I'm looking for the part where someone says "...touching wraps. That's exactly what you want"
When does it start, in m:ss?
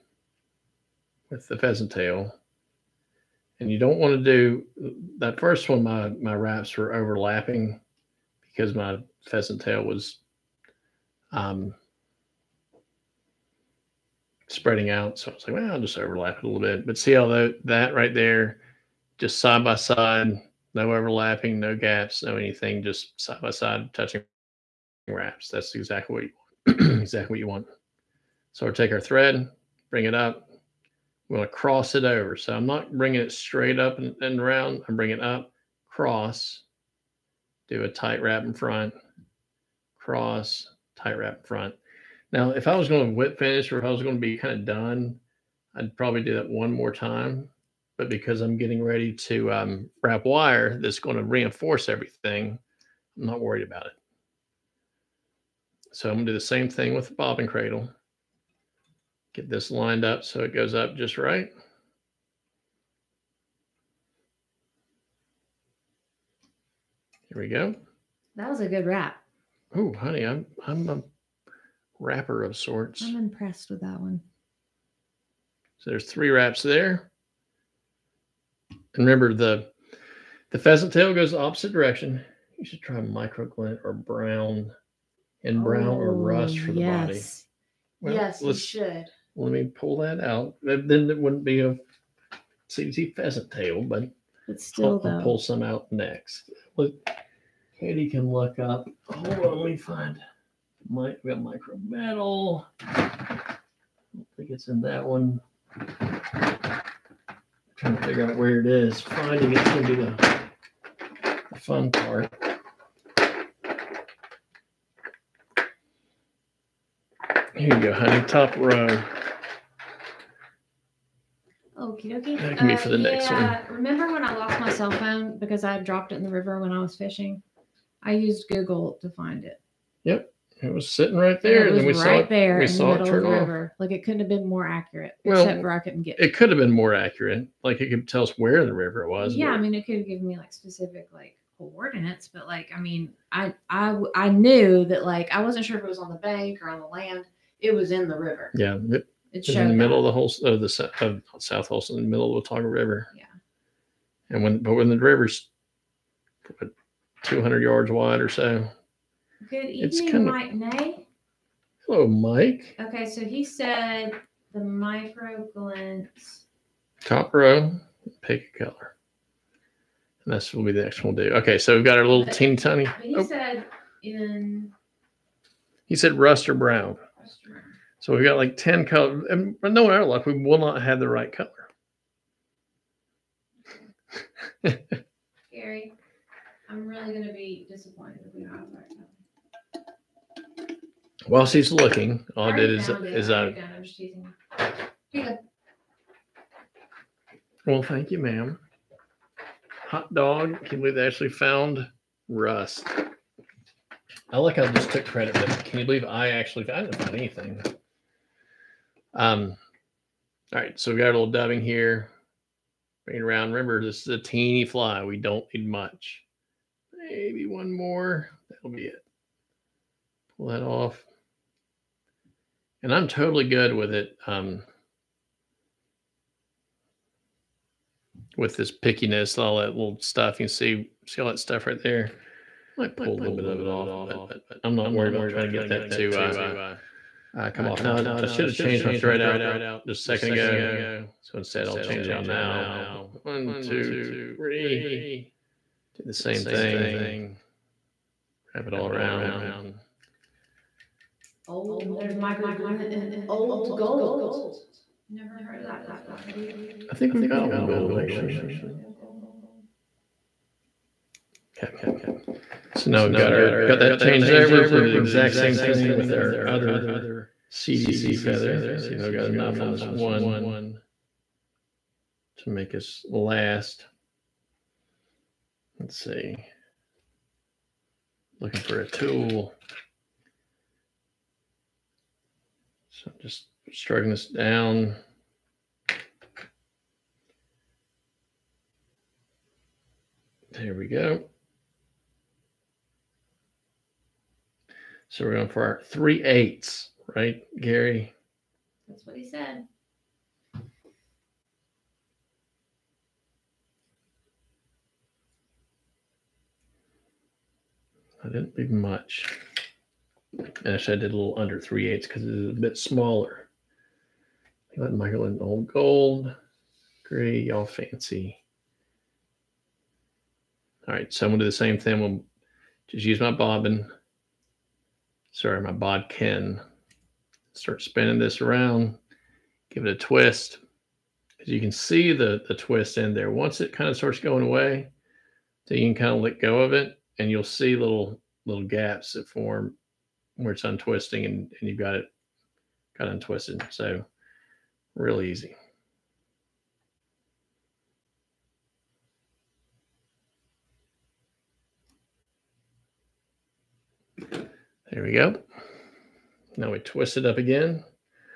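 0:23.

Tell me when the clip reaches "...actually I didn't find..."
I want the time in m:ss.
3:26.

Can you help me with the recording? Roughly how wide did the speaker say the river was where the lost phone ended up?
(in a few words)
200 yards.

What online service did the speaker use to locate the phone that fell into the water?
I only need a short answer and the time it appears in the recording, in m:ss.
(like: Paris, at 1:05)
Google, at 2:08.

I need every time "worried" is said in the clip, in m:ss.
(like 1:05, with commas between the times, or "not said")
0:53, 3:54.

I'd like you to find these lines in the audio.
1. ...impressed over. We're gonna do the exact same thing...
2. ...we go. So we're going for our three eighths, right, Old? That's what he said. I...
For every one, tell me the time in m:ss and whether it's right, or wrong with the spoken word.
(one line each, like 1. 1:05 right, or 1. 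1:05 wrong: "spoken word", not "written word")
1. 4:23 wrong: "changed", not "impressed"
2. 4:50 wrong: "Gary", not "Old".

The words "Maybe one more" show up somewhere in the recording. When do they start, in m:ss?
3:36.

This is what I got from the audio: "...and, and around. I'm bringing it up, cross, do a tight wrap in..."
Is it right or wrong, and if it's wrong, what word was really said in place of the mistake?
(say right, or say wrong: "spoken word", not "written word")
right.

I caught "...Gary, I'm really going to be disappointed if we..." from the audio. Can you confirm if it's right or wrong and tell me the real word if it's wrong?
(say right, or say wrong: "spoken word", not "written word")
right.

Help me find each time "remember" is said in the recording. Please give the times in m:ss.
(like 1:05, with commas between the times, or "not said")
1:19, 2:03, 3:33.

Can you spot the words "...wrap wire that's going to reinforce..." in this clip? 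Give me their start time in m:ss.
0:50.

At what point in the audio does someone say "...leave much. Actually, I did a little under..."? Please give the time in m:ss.
5:08.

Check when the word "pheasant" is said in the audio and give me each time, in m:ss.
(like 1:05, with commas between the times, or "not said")
0:01, 0:09, 1:20, 1:33.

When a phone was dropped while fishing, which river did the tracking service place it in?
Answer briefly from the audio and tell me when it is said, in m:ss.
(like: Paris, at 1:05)
Watauga River, at 2:32.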